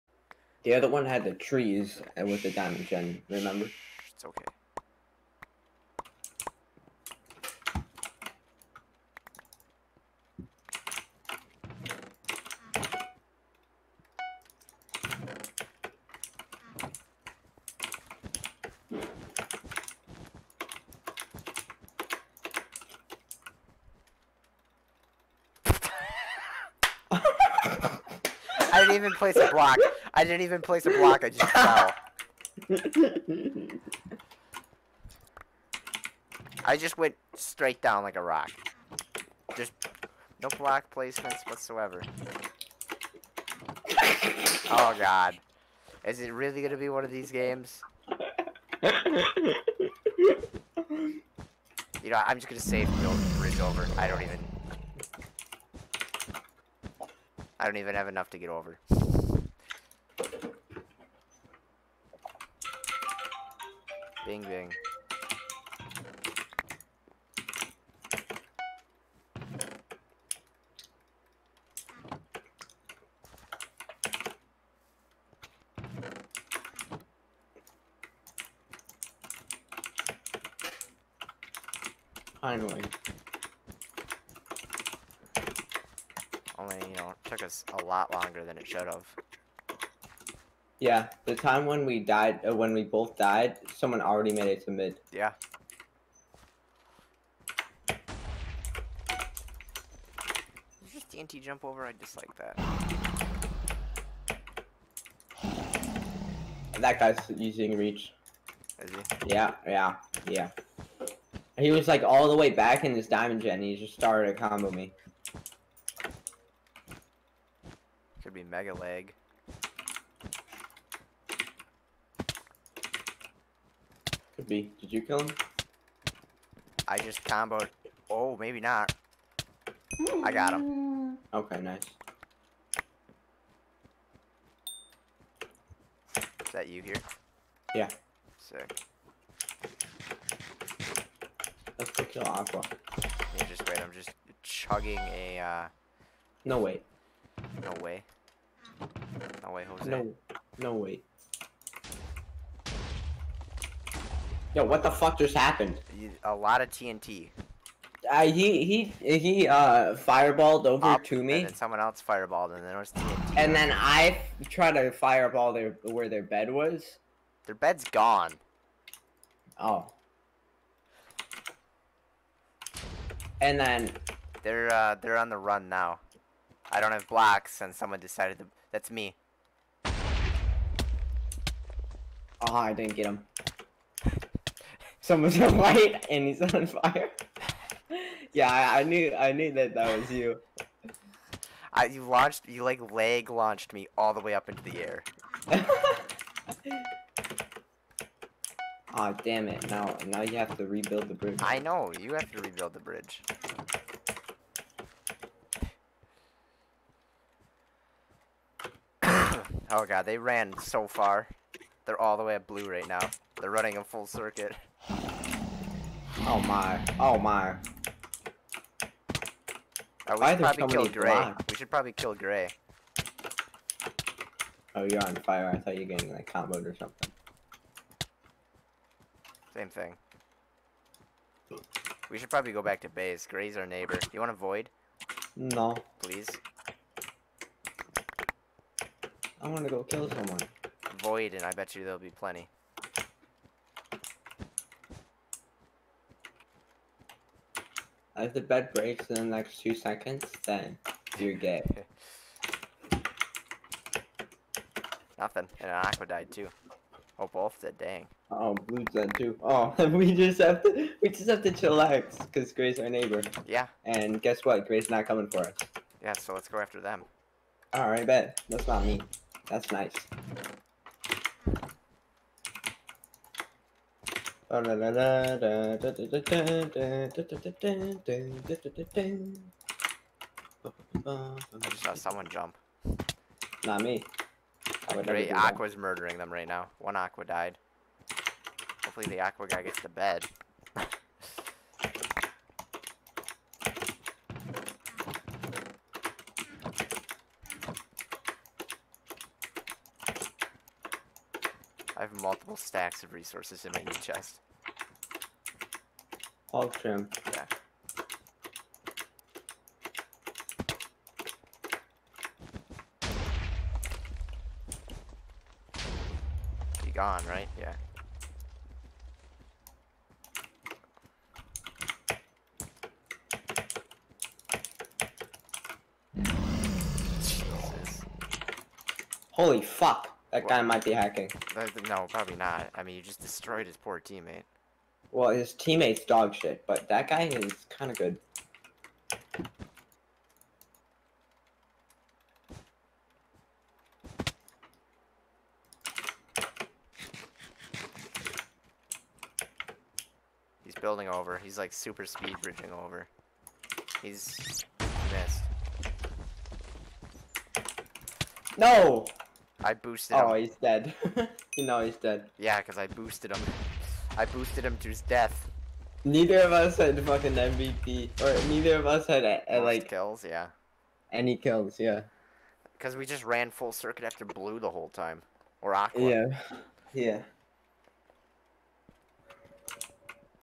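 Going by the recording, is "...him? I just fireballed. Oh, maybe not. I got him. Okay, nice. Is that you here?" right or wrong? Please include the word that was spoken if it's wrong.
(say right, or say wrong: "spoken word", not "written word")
wrong: "comboed", not "fireballed".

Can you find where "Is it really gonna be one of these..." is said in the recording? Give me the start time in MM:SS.
00:46.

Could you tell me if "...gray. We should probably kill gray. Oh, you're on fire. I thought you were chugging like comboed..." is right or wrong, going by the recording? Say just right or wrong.
wrong.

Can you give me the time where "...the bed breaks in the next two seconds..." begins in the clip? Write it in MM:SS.
04:08.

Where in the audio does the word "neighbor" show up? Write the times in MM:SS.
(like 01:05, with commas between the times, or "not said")
03:53, 04:22.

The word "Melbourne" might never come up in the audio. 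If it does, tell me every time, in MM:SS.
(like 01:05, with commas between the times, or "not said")
not said.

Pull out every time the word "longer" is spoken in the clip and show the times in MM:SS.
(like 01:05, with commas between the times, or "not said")
01:28.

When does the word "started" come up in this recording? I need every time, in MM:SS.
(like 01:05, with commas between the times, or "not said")
01:53.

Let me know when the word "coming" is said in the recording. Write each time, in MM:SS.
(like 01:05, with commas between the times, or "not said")
04:25.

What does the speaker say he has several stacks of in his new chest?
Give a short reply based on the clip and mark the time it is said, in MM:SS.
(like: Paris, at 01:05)
resources, at 05:03.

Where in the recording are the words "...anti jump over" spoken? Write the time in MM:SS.
01:41.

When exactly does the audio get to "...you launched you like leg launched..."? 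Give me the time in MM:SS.
03:11.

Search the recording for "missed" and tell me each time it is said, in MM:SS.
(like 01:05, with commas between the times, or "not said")
05:55.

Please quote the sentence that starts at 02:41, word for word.
And then someone else fireballed, and then it was TNT.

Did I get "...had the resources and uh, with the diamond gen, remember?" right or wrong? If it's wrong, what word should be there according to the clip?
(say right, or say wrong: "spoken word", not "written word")
wrong: "trees", not "resources".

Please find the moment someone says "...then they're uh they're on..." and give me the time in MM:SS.
02:53.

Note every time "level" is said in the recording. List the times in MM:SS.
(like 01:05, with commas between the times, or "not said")
not said.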